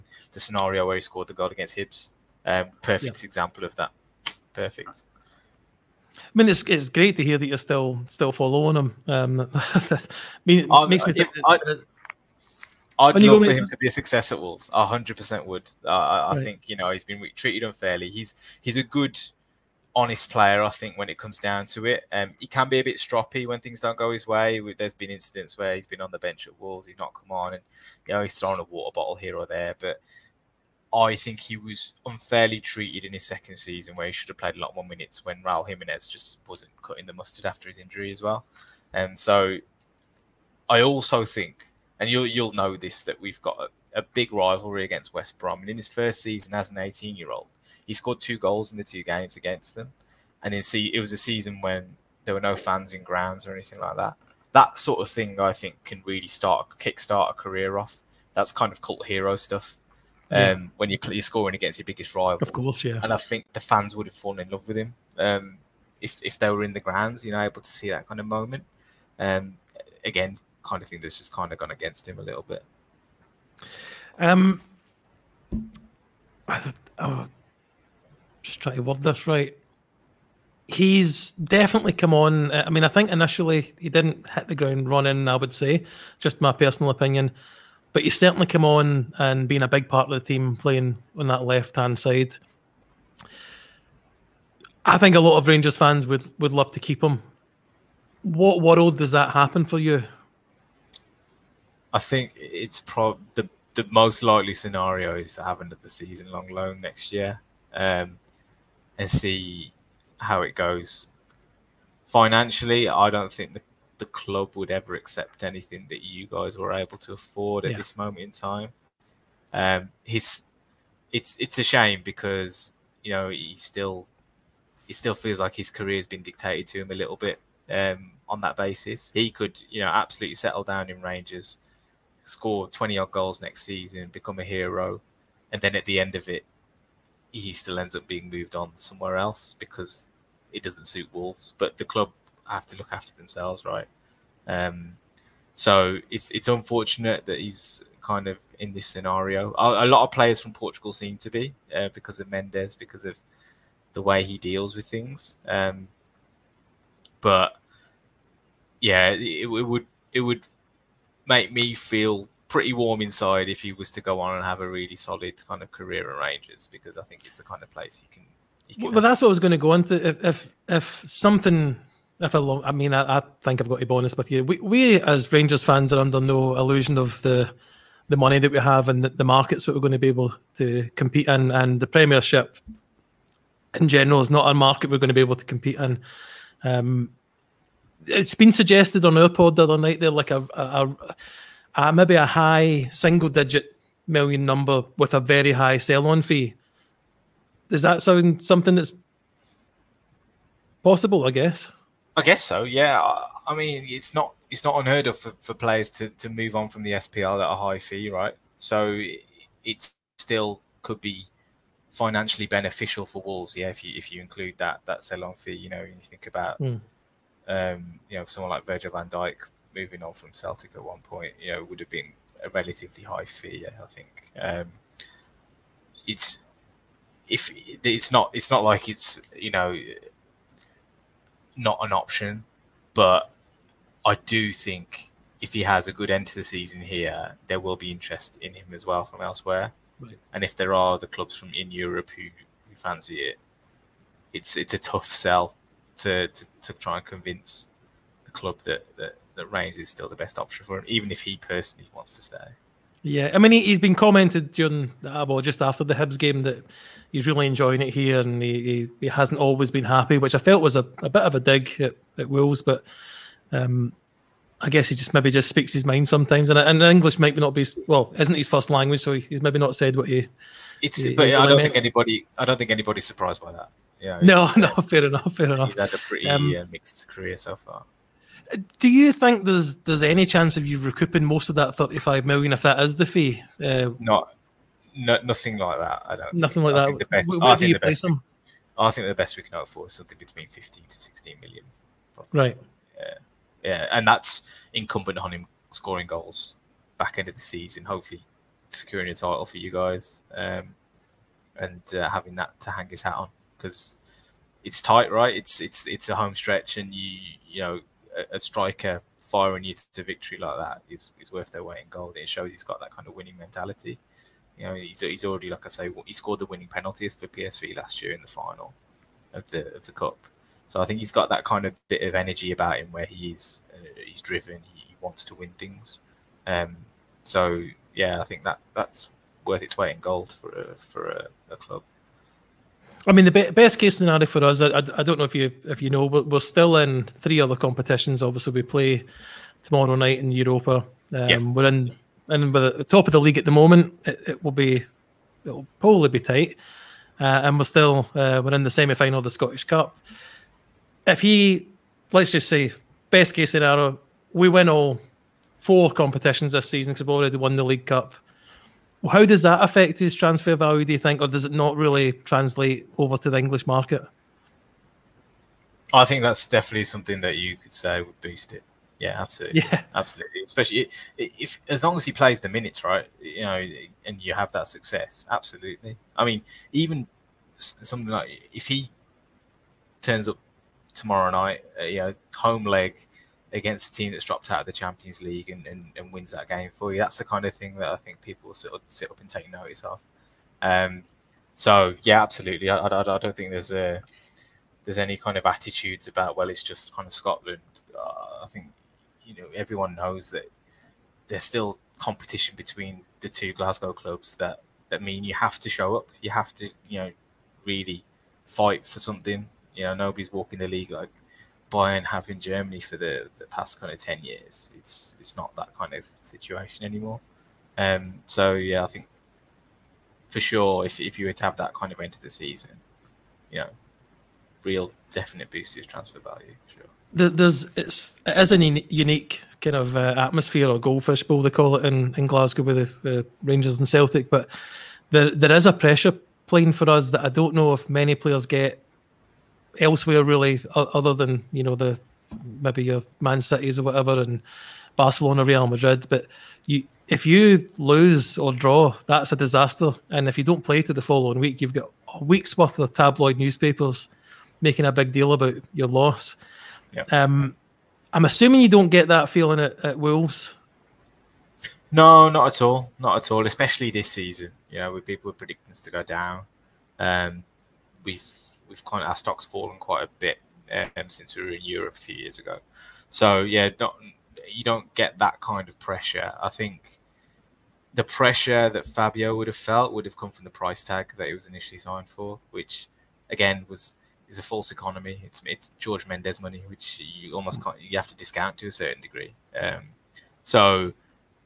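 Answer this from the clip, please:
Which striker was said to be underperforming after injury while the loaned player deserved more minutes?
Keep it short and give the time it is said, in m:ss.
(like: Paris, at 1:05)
Raul Jimenez, at 0:35.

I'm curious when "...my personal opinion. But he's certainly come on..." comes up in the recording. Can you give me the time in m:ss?
1:26.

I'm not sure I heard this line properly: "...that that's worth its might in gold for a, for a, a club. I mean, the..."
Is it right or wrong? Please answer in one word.
wrong.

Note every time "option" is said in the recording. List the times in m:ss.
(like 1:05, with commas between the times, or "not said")
3:51, 4:10.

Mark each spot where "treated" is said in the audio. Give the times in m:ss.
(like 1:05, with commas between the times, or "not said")
0:17, 0:32.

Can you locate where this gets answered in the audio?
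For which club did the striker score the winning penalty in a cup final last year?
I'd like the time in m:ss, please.
5:17.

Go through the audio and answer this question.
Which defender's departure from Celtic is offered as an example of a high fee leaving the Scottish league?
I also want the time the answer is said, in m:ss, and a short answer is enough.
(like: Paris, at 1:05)
Virgil van Dijk, at 3:38.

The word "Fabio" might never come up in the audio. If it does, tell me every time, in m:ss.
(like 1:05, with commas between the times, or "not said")
7:58.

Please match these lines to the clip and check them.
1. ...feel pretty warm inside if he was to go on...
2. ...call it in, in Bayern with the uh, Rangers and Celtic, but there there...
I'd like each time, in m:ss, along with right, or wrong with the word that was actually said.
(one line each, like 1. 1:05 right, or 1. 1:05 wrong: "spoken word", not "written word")
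1. 2:41 right
2. 7:11 wrong: "Glasgow", not "Bayern".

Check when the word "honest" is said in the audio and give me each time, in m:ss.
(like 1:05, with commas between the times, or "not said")
0:19, 2:53.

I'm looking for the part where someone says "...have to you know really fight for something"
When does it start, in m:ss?
6:46.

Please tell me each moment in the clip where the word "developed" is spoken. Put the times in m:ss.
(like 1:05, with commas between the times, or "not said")
not said.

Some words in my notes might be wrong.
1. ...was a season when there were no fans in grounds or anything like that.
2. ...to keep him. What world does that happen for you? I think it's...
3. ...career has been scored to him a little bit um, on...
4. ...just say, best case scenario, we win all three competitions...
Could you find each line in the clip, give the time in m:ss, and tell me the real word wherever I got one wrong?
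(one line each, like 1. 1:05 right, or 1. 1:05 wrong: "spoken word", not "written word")
1. 0:50 right
2. 1:36 right
3. 2:05 wrong: "dictated", not "scored"
4. 5:52 wrong: "four", not "three".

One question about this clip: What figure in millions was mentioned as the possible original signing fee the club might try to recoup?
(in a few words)
35 million.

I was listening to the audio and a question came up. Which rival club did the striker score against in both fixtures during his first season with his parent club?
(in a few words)
West Brom.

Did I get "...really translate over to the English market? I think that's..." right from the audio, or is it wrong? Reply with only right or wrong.
right.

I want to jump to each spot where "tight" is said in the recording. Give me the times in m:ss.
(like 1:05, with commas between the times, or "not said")
5:04, 5:46.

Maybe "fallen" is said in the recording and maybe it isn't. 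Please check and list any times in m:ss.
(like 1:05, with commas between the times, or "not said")
1:04, 7:49.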